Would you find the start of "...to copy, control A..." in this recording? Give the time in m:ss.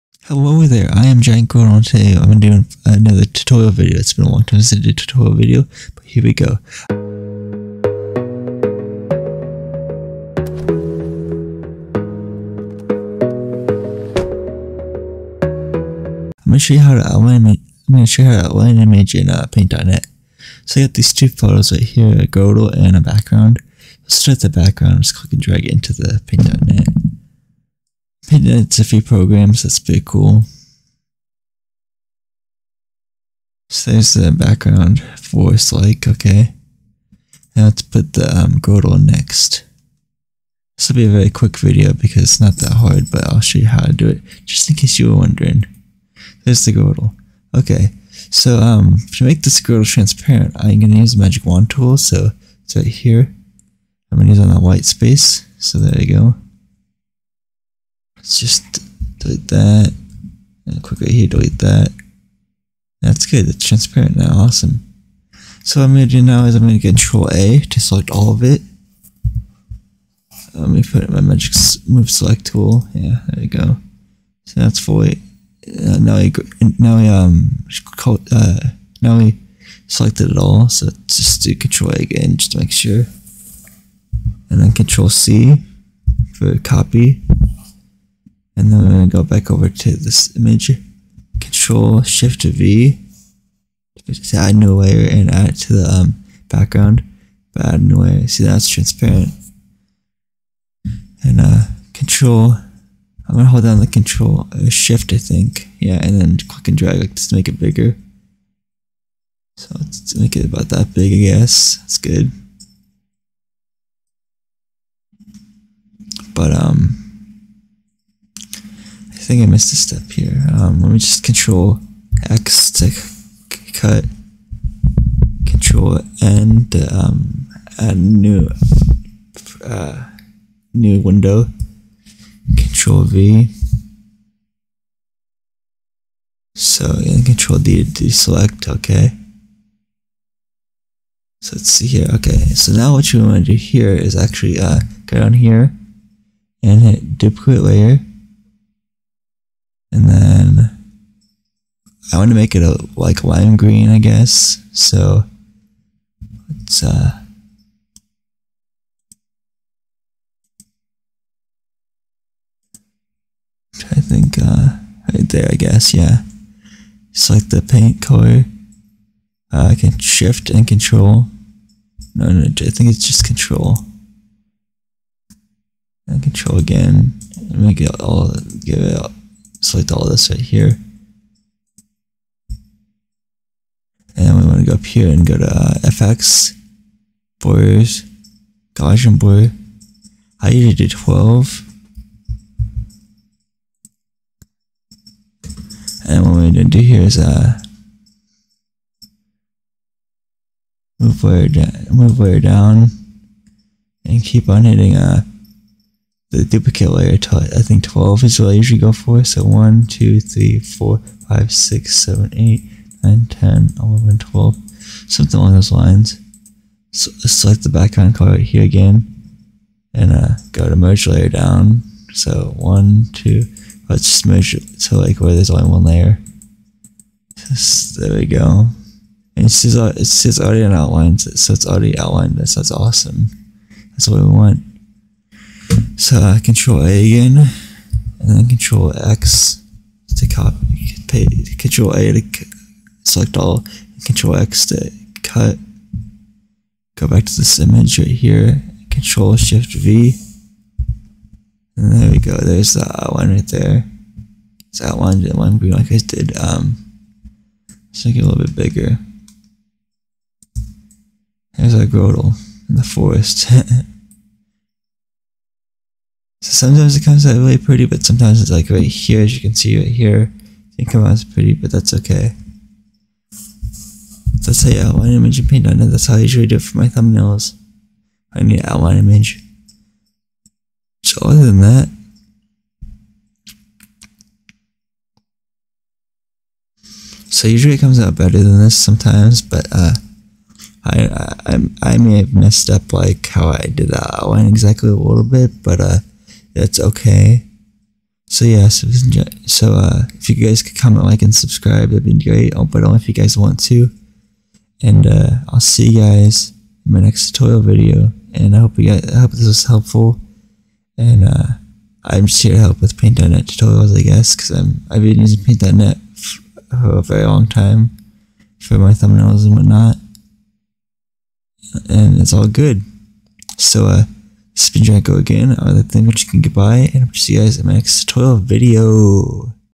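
4:00.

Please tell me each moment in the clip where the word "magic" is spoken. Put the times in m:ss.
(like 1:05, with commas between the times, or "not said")
0:51, 1:11.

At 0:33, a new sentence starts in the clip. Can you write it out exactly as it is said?
So there's the background voice like, okay.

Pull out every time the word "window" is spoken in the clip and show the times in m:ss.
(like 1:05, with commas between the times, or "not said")
2:10.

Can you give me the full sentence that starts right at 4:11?
And there we go, there's the one right there.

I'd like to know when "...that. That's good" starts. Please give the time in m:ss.
1:01.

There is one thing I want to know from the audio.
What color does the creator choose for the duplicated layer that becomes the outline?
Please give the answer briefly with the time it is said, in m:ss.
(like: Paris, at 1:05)
Lime green, at 2:33.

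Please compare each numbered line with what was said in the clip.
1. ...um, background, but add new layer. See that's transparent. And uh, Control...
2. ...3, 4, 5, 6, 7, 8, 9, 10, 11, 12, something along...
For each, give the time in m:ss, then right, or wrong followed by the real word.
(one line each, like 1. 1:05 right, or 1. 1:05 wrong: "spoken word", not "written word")
1. 1:35 right
2. 3:30 right.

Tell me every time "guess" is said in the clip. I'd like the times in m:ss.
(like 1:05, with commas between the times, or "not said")
1:51, 2:33, 2:45, 5:14.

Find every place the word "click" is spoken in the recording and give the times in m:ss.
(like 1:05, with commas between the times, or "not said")
0:25, 1:46.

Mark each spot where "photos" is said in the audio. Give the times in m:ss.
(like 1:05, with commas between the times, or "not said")
0:21.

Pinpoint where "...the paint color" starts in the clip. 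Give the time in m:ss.
2:47.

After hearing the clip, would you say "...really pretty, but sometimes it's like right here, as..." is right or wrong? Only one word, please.
right.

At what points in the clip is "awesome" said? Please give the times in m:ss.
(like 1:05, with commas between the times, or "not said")
1:04, 3:52.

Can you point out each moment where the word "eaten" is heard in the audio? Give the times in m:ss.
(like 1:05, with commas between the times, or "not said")
not said.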